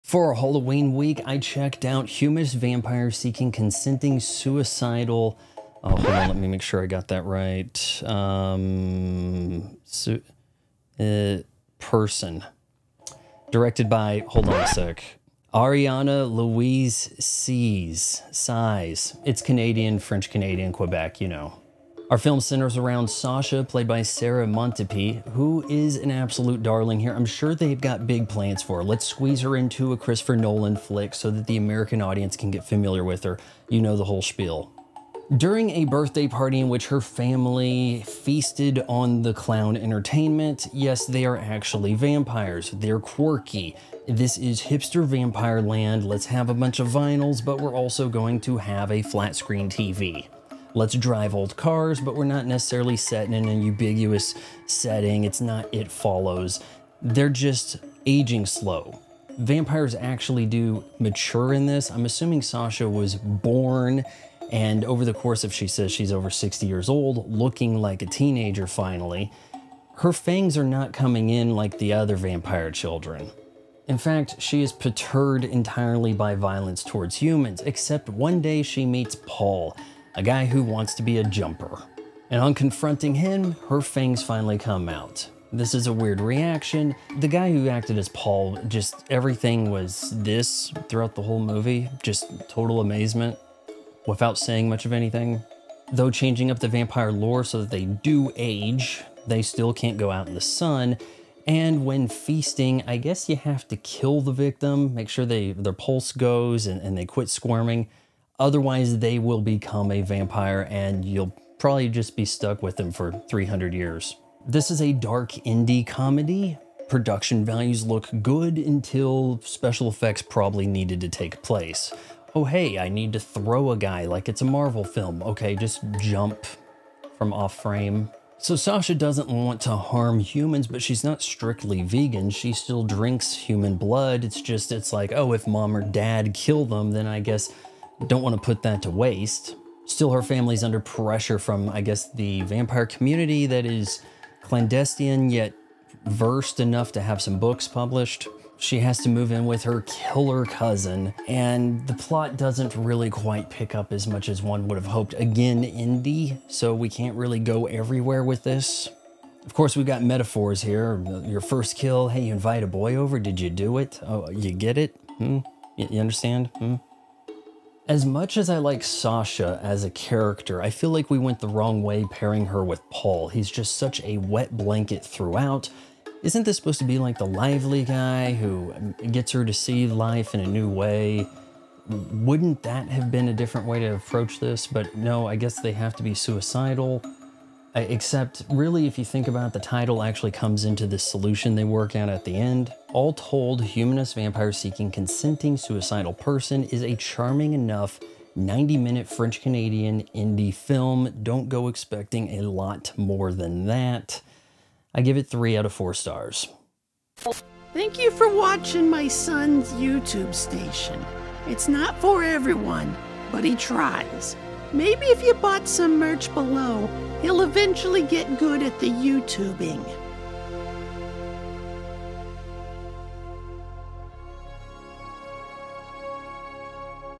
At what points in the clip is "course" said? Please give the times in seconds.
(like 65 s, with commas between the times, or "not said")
65 s, 159 s.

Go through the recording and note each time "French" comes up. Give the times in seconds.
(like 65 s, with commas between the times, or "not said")
19 s, 199 s.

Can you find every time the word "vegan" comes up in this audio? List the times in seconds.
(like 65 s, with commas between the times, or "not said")
131 s.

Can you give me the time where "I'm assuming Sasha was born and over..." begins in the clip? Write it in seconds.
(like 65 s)
61 s.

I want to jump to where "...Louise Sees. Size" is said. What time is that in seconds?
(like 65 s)
16 s.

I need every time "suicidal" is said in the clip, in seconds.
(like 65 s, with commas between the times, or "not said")
4 s, 186 s, 195 s.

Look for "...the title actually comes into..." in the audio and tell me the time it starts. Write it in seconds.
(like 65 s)
189 s.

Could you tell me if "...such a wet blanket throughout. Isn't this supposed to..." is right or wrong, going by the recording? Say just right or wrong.
right.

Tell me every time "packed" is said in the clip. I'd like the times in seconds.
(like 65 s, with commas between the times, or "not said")
not said.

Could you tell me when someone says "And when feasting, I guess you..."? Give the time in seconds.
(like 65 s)
101 s.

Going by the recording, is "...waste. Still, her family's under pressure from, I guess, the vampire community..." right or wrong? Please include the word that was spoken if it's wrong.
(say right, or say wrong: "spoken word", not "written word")
right.